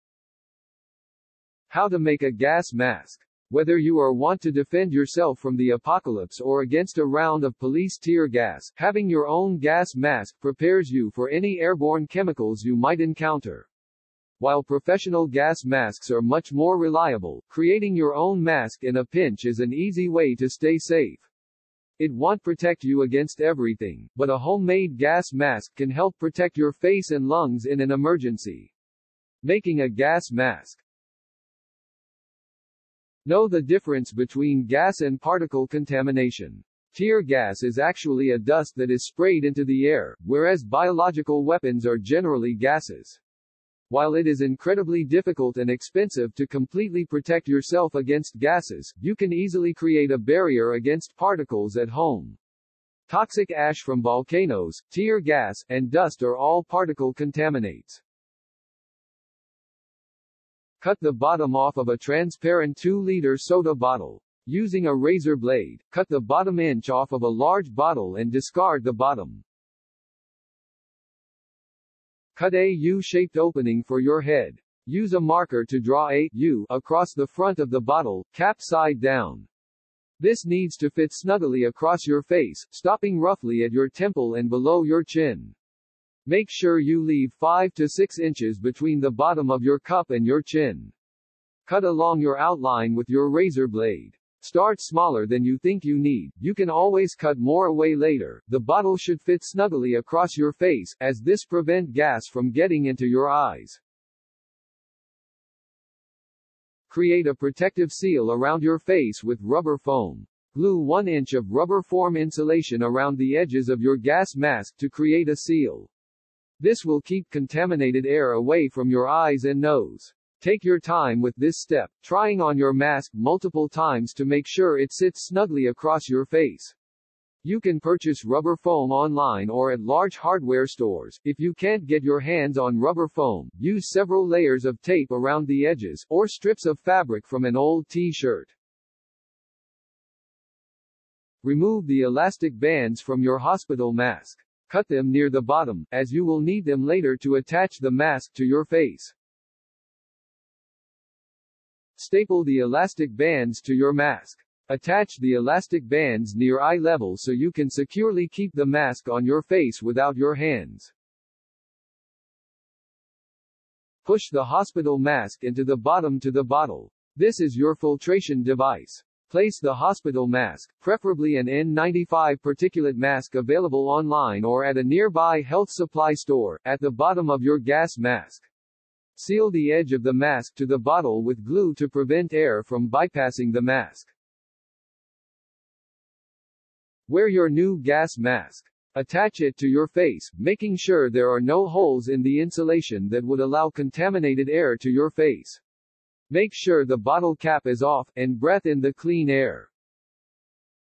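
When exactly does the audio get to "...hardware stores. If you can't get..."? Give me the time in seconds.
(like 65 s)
130 s.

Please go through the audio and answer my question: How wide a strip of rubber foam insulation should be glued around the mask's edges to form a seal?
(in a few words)
1 inch.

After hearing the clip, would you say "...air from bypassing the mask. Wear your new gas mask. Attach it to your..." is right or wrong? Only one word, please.
right.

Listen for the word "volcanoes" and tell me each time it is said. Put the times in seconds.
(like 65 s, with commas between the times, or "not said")
54 s.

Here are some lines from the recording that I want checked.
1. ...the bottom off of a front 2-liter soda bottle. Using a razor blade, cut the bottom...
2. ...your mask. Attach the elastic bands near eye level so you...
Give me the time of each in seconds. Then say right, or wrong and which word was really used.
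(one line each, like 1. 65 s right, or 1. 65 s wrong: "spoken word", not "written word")
1. 60 s wrong: "transparent", not "front"
2. 153 s right.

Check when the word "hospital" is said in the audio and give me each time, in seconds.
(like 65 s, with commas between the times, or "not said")
143 s, 164 s, 169 s.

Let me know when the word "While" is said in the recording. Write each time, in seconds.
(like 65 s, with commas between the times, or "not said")
14 s, 43 s.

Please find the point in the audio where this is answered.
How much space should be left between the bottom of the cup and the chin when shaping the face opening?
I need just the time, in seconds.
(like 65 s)
87 s.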